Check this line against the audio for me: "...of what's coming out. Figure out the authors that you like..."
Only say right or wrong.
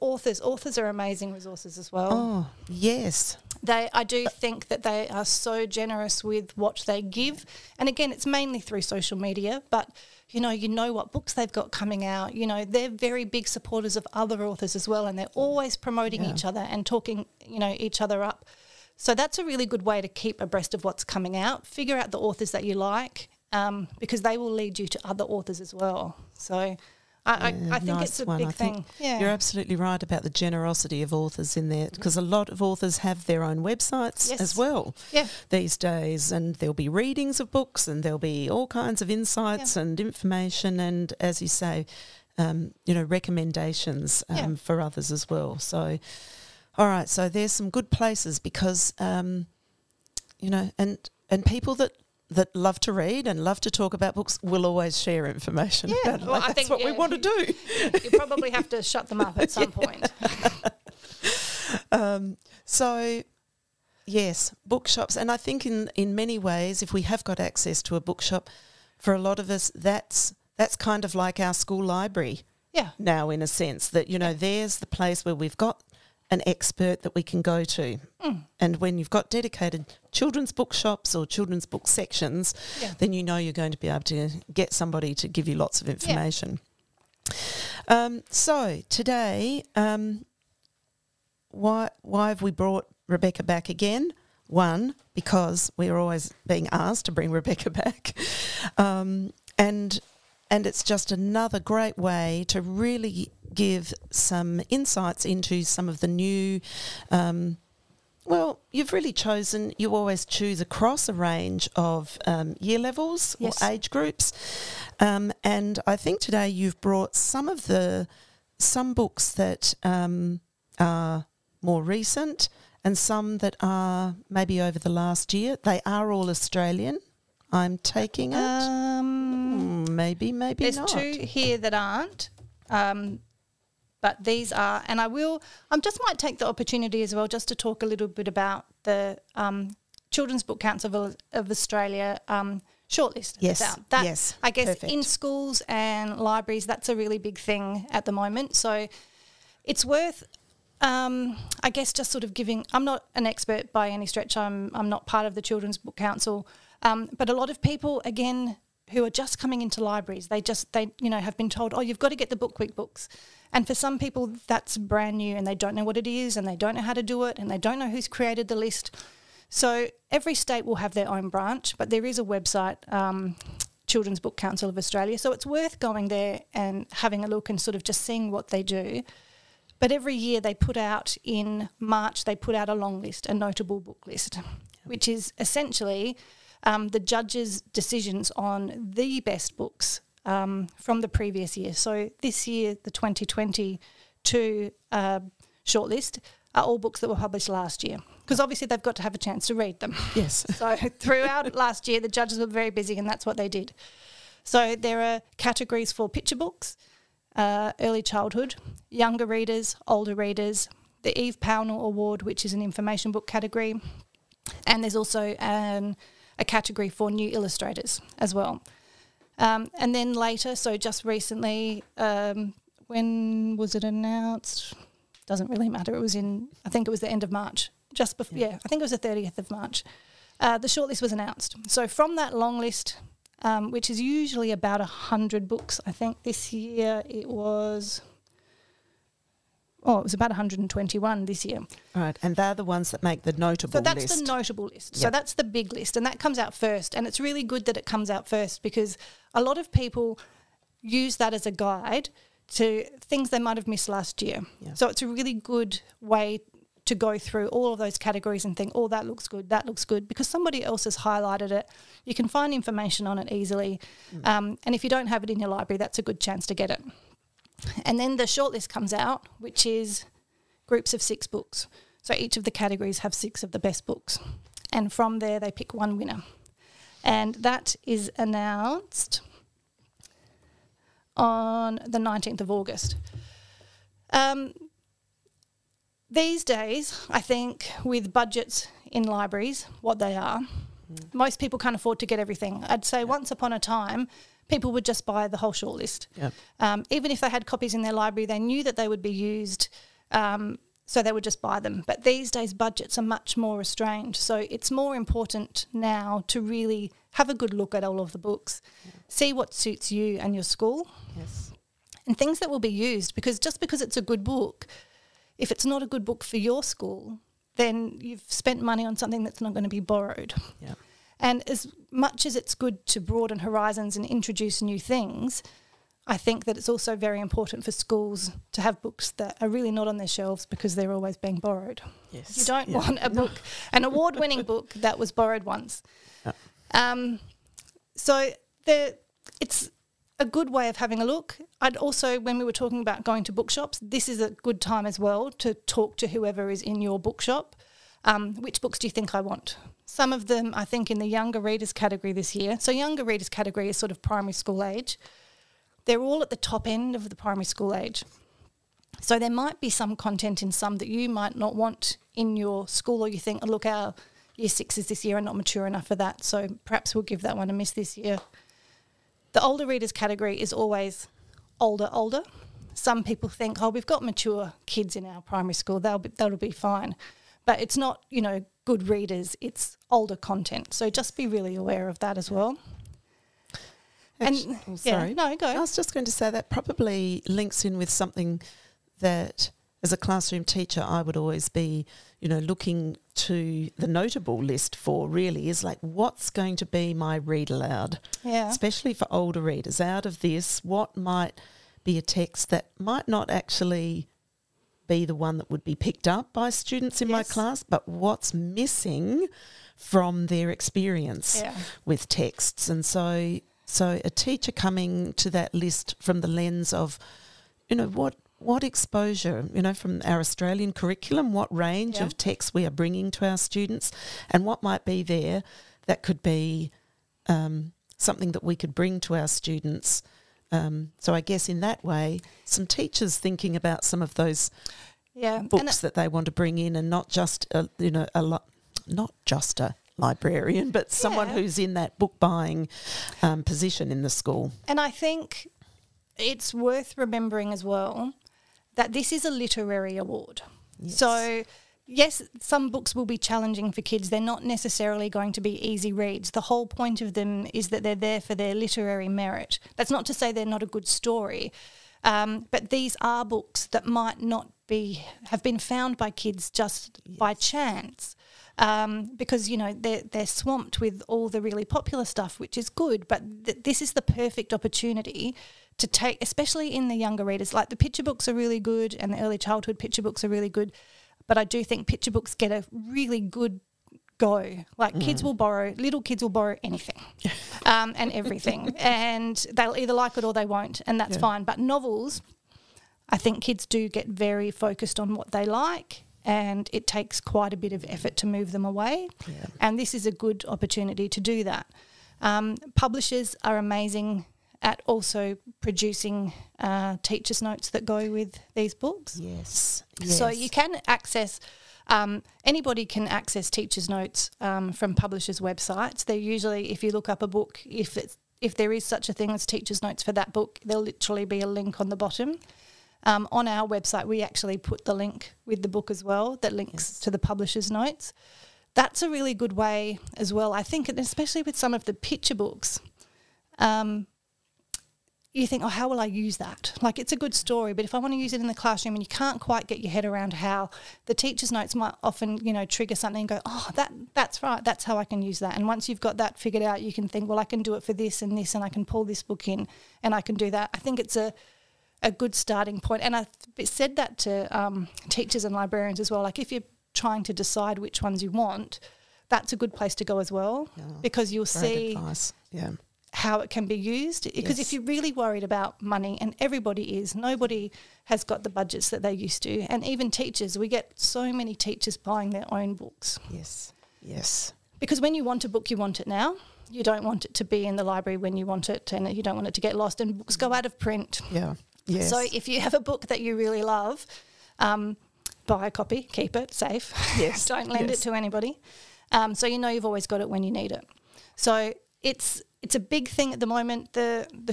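right.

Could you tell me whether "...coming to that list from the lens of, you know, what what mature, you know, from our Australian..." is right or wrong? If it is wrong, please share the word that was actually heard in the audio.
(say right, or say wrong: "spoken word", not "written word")
wrong: "exposure", not "mature".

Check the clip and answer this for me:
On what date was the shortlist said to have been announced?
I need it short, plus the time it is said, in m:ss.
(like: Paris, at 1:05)
30th of March, at 3:48.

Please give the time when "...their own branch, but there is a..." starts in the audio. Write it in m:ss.
2:50.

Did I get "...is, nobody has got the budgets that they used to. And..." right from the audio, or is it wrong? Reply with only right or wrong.
right.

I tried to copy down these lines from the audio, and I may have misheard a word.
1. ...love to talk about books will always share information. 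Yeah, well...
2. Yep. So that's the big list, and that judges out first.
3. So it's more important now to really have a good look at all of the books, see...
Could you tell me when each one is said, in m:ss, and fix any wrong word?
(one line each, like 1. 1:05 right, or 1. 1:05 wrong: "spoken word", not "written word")
1. 0:53 right
2. 4:04 wrong: "comes", not "judges"
3. 5:04 right.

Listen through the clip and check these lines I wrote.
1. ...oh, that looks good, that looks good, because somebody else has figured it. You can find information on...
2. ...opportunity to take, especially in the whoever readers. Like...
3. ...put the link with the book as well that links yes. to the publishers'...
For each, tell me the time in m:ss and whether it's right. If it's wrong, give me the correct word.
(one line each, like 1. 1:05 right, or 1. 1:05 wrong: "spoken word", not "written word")
1. 4:18 wrong: "highlighted", not "figured"
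2. 7:54 wrong: "younger", not "whoever"
3. 8:44 right.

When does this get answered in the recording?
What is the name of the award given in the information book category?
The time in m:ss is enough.
3:31.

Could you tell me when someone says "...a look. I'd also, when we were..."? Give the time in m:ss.
5:41.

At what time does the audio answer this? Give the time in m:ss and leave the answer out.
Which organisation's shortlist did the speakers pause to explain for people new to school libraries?
2:20.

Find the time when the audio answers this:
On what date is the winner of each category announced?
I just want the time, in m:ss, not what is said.
4:41.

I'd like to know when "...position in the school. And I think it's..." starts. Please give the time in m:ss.
7:23.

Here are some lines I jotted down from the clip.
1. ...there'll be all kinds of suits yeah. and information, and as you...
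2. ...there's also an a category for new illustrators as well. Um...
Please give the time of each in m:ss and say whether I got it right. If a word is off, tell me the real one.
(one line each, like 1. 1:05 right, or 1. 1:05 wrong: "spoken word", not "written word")
1. 0:38 wrong: "insights", not "suits"
2. 3:34 right.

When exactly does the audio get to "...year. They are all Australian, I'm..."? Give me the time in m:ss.
2:05.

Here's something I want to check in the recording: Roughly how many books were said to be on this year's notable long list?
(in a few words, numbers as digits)
121.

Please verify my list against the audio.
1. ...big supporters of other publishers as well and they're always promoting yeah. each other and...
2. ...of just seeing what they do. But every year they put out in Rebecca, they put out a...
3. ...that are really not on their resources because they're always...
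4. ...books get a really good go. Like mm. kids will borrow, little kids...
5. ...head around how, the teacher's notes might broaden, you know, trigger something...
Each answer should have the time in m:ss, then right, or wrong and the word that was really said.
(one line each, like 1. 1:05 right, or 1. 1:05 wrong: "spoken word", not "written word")
1. 0:13 wrong: "authors", not "publishers"
2. 2:57 wrong: "March", not "Rebecca"
3. 5:29 wrong: "shelves", not "resources"
4. 8:02 right
5. 8:59 wrong: "often", not "broaden".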